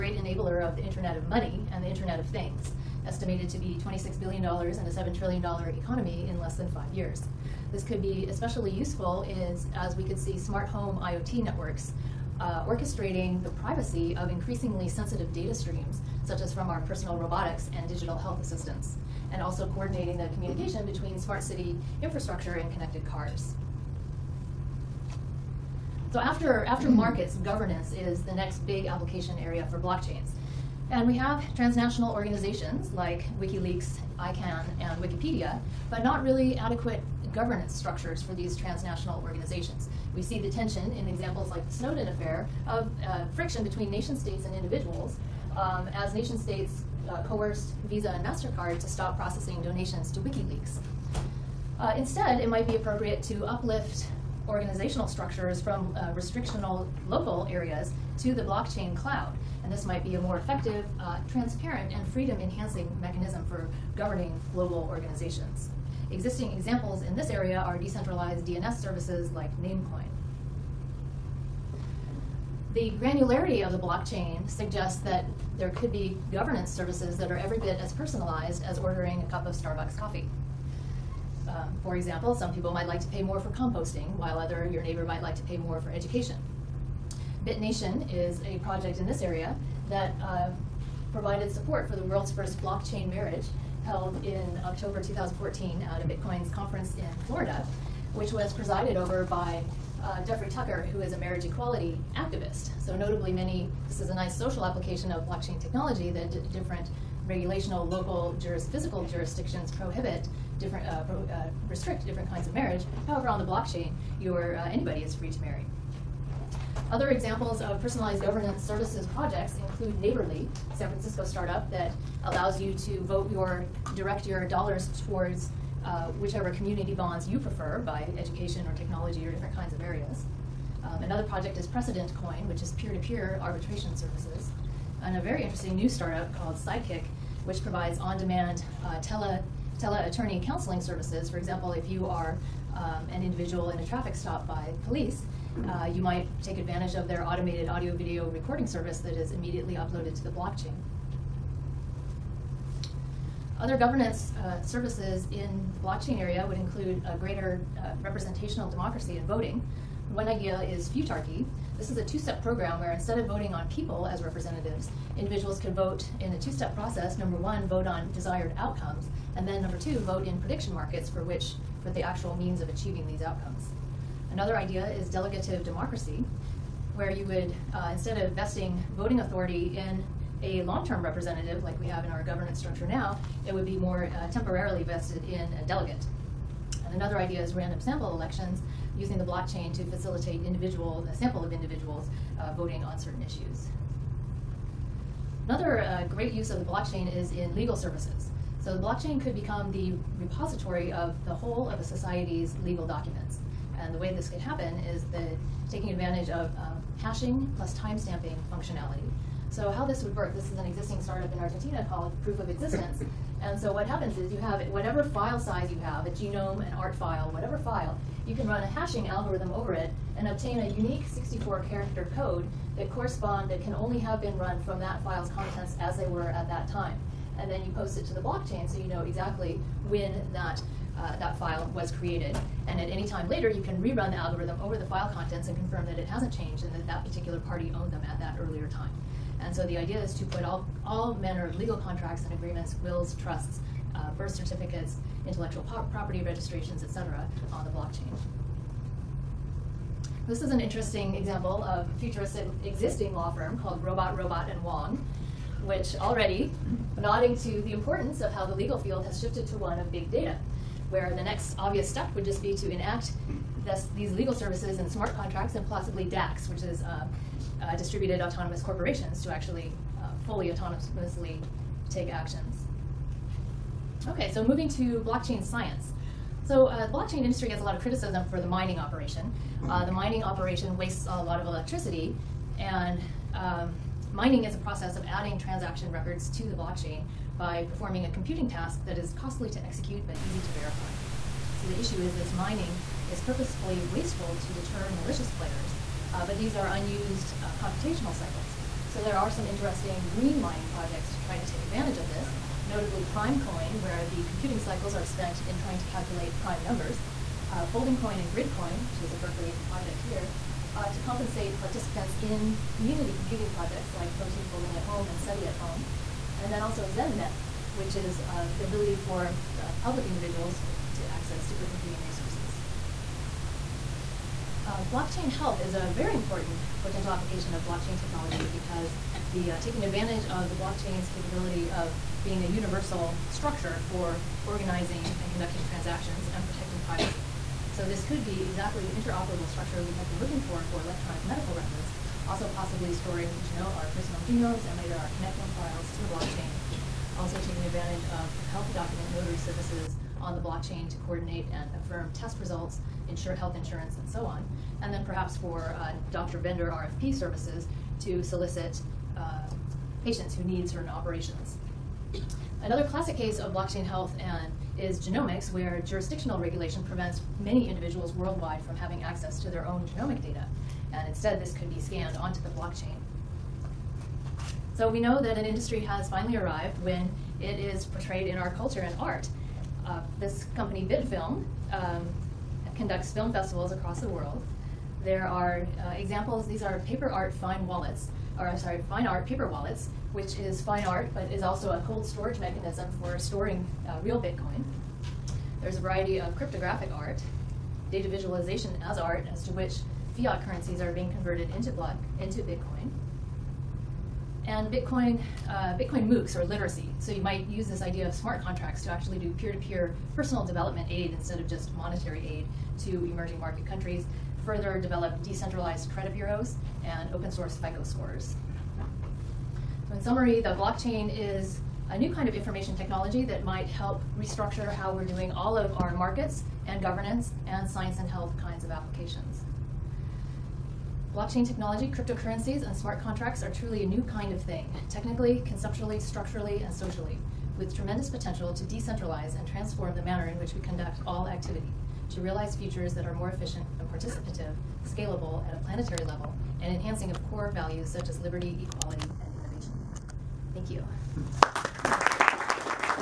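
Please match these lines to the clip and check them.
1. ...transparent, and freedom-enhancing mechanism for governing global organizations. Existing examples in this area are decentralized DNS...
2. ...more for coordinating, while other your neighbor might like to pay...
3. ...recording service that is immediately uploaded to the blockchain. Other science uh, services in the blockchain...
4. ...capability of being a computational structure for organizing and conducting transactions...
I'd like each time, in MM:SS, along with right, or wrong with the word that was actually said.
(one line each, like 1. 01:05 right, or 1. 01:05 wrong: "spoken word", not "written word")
1. 01:01 right
2. 01:23 wrong: "composting", not "coordinating"
3. 02:28 wrong: "governance", not "science"
4. 05:31 wrong: "universal", not "computational".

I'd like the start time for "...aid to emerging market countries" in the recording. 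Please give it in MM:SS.
06:52.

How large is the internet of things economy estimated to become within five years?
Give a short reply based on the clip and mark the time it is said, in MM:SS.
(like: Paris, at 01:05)
$7 trillion, at 00:04.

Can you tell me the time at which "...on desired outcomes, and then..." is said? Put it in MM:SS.
02:47.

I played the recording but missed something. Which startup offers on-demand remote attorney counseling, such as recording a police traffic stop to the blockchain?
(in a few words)
Sidekick.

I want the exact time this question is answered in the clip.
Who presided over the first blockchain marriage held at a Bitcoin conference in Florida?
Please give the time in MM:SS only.
01:40.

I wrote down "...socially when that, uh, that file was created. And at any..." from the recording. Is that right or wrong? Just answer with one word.
wrong.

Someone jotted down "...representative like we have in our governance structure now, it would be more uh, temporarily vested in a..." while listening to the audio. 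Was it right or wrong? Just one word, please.
right.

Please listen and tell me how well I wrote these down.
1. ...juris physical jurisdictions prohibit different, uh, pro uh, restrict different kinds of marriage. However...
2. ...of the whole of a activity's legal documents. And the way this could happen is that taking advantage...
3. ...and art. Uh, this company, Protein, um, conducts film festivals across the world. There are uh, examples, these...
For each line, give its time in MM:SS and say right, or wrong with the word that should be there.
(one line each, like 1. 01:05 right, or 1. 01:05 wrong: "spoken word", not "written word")
1. 01:48 right
2. 03:20 wrong: "society", not "activity"
3. 06:18 wrong: "Bitfilm", not "Protein".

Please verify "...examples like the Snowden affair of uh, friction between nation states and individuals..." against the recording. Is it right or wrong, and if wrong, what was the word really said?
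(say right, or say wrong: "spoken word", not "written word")
right.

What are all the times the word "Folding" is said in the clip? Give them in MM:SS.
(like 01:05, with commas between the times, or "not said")
05:07, 05:14.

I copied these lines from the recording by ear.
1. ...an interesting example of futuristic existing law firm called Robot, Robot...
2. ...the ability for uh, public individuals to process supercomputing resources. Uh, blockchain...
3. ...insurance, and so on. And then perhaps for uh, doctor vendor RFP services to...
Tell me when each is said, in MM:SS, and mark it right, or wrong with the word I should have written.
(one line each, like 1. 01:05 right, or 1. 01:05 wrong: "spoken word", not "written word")
1. 04:10 right
2. 05:18 wrong: "access", not "process"
3. 05:53 right.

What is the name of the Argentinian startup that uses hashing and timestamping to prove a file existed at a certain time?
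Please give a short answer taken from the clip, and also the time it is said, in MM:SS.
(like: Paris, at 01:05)
Proof of Existence, at 03:32.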